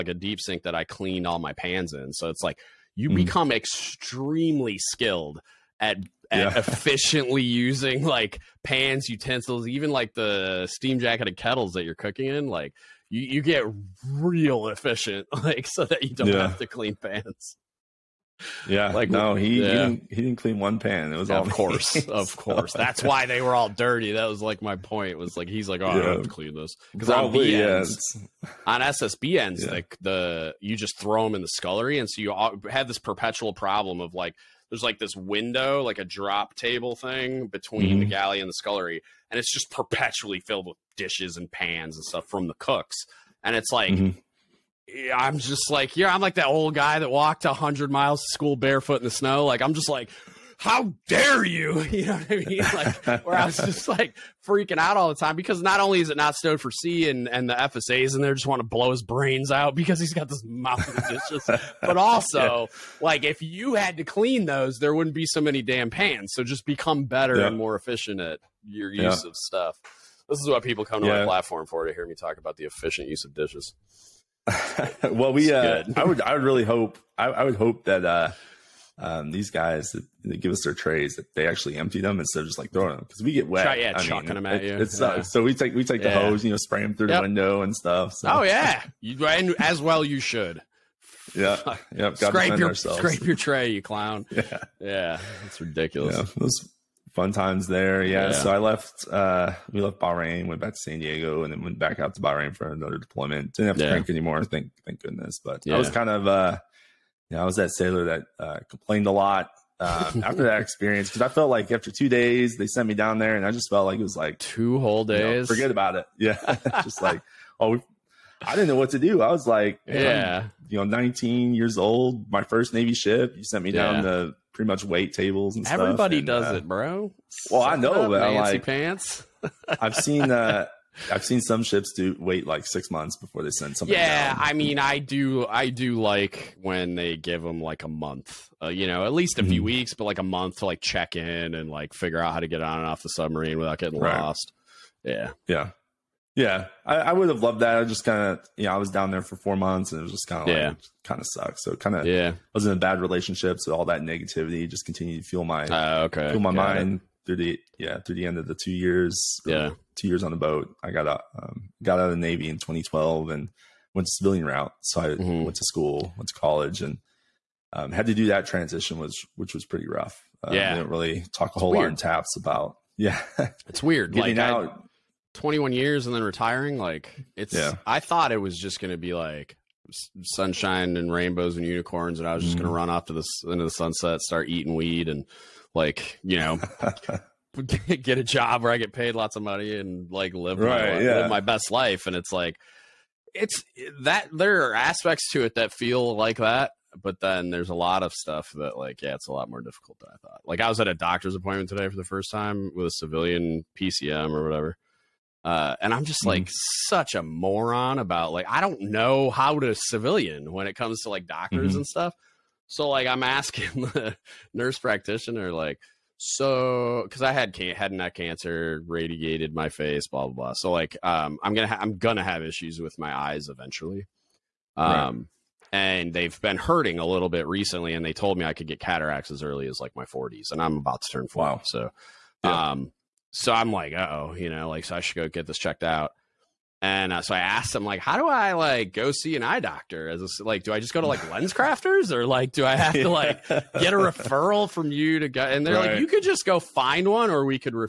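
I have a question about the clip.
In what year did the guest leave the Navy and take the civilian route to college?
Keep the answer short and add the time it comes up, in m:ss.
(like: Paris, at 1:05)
2012, at 2:42.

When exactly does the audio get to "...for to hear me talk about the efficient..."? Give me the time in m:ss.
1:11.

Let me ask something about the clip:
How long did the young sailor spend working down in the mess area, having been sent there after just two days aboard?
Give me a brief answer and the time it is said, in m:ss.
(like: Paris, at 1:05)
4 months, at 2:29.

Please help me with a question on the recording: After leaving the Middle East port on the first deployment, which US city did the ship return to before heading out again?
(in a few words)
San Diego.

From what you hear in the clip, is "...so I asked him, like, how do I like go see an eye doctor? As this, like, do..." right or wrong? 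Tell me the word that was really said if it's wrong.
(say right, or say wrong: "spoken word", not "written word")
right.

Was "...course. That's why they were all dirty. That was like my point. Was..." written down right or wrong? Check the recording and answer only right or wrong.
right.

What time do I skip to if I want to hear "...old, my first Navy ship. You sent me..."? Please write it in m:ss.
2:01.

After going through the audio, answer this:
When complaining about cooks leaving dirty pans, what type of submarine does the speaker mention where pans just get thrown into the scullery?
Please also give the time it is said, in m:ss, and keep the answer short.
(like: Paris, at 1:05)
SSBNs, at 0:28.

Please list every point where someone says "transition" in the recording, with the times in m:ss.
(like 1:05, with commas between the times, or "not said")
2:48.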